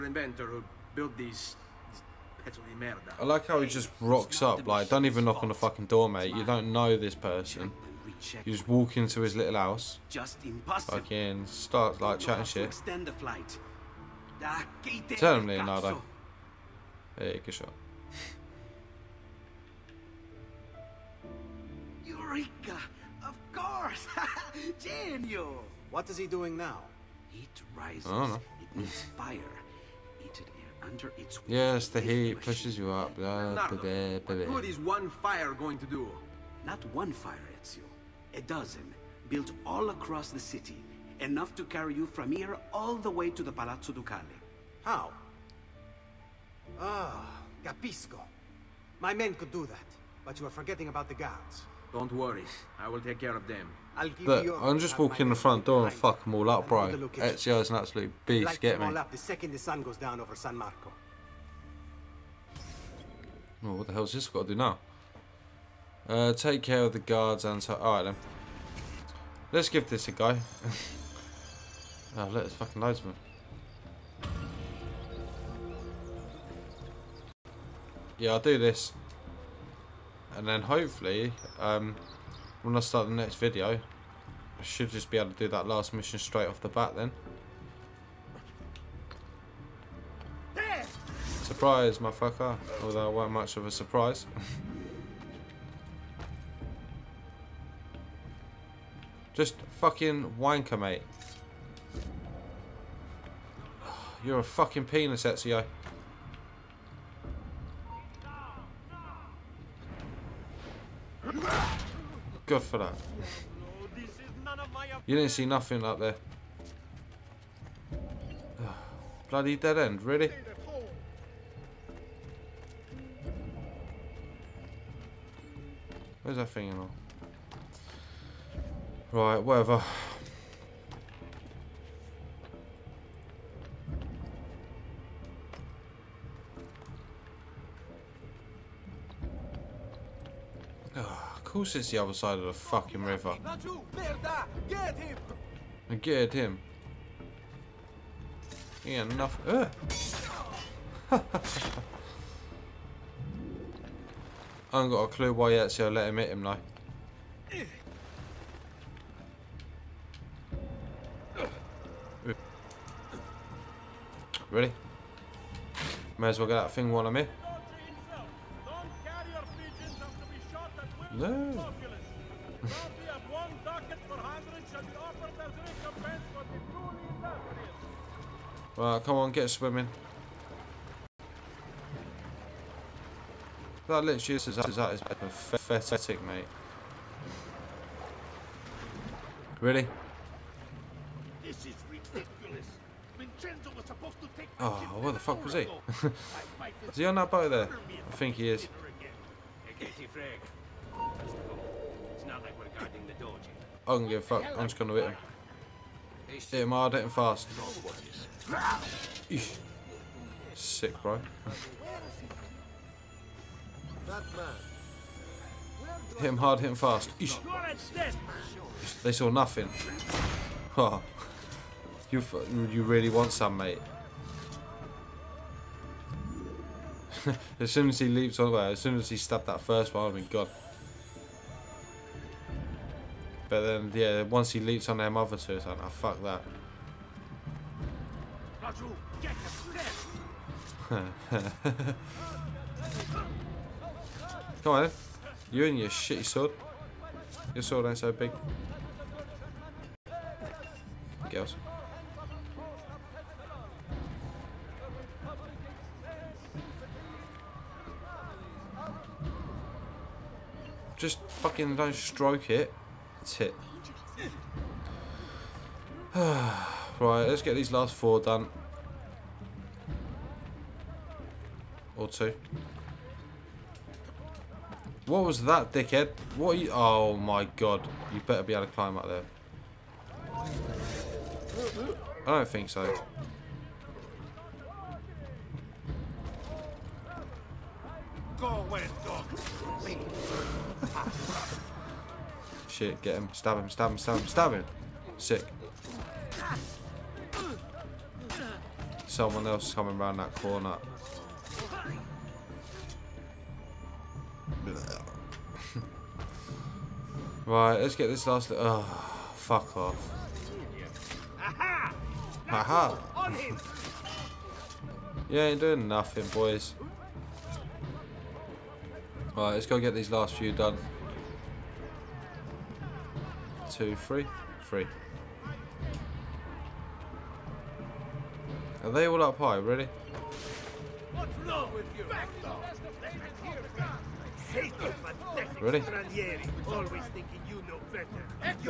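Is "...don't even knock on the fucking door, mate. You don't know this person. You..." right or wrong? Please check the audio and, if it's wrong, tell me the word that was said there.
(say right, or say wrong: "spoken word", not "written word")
right.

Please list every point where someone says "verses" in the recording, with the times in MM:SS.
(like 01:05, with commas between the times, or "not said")
not said.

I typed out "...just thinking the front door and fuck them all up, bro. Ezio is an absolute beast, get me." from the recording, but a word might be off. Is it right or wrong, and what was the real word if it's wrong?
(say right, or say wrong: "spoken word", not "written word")
wrong: "walking", not "thinking".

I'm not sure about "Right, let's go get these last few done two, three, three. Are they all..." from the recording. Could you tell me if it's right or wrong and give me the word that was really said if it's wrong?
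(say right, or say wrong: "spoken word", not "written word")
right.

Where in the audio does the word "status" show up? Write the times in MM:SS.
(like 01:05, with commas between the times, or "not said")
not said.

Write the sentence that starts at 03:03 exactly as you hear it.
That literally is that is that is pathetic, mate.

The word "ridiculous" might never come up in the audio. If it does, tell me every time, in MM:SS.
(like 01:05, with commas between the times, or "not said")
03:11.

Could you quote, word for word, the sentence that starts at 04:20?
Just fucking don't stroke it tip.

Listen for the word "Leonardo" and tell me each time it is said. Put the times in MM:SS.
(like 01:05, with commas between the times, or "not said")
00:15.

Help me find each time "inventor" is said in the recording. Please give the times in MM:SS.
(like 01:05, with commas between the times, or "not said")
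00:00.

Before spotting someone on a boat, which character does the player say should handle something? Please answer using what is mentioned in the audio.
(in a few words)
Vincenzo.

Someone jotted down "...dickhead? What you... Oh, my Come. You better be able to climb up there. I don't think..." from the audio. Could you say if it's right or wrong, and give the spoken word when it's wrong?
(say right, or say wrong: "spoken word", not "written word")
wrong: "God", not "Come".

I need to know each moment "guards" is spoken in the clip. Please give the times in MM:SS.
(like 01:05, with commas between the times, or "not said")
00:51, 01:06.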